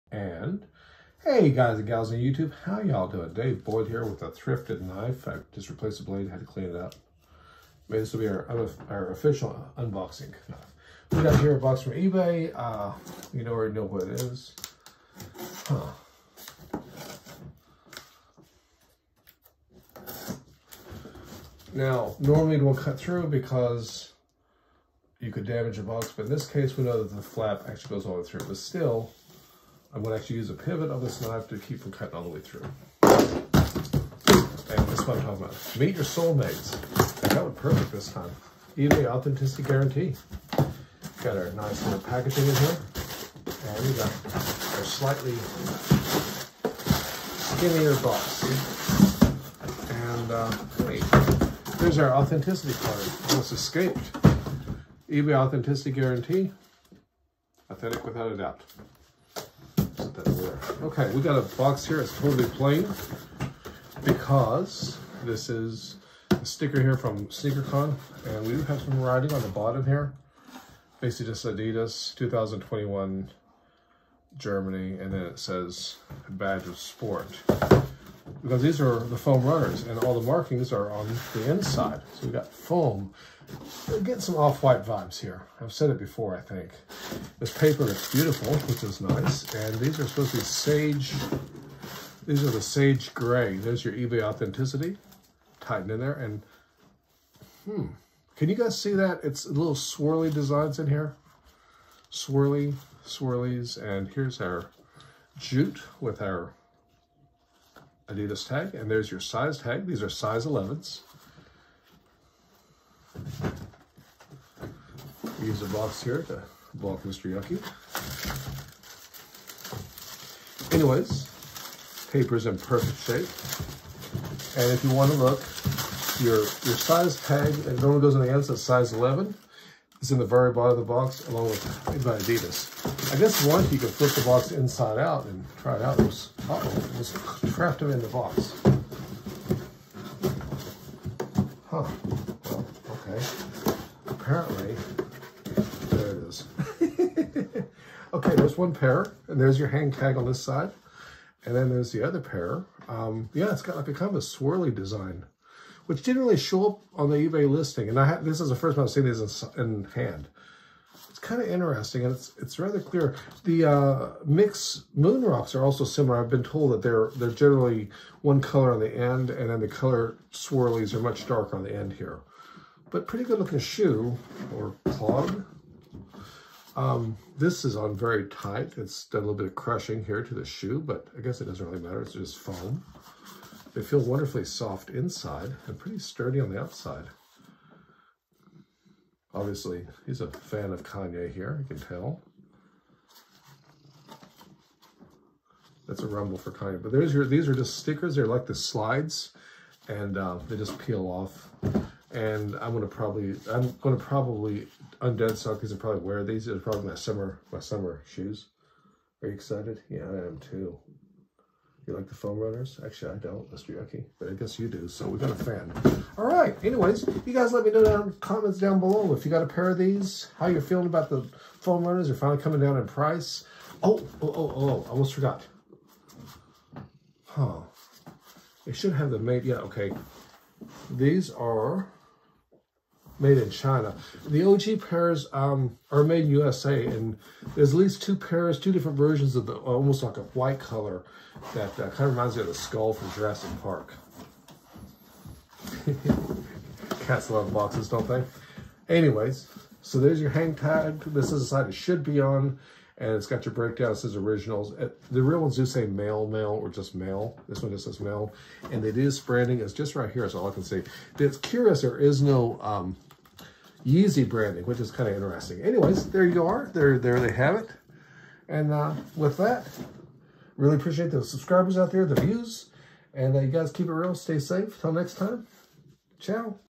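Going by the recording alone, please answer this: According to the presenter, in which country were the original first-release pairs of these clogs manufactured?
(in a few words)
USA.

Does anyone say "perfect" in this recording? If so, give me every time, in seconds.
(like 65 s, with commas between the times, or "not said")
37 s, 122 s.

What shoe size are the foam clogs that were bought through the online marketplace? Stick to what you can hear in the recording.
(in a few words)
11.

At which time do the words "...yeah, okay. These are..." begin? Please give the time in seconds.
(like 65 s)
229 s.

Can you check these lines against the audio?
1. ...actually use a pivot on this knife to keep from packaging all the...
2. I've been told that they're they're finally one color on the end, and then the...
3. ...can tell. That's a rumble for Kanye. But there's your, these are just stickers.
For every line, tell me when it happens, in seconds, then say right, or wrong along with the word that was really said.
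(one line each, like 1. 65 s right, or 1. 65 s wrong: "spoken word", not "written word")
1. 30 s wrong: "cutting", not "packaging"
2. 166 s wrong: "generally", not "finally"
3. 191 s right.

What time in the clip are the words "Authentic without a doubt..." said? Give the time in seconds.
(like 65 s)
57 s.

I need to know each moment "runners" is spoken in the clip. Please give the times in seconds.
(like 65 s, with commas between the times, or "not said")
79 s, 212 s, 221 s.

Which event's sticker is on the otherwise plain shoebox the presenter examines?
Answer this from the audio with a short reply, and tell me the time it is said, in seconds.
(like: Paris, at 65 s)
SneakerCon, at 67 s.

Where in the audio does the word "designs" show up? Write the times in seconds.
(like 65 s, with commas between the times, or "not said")
100 s, 154 s.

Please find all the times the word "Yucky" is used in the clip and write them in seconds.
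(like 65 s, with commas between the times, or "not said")
117 s, 213 s.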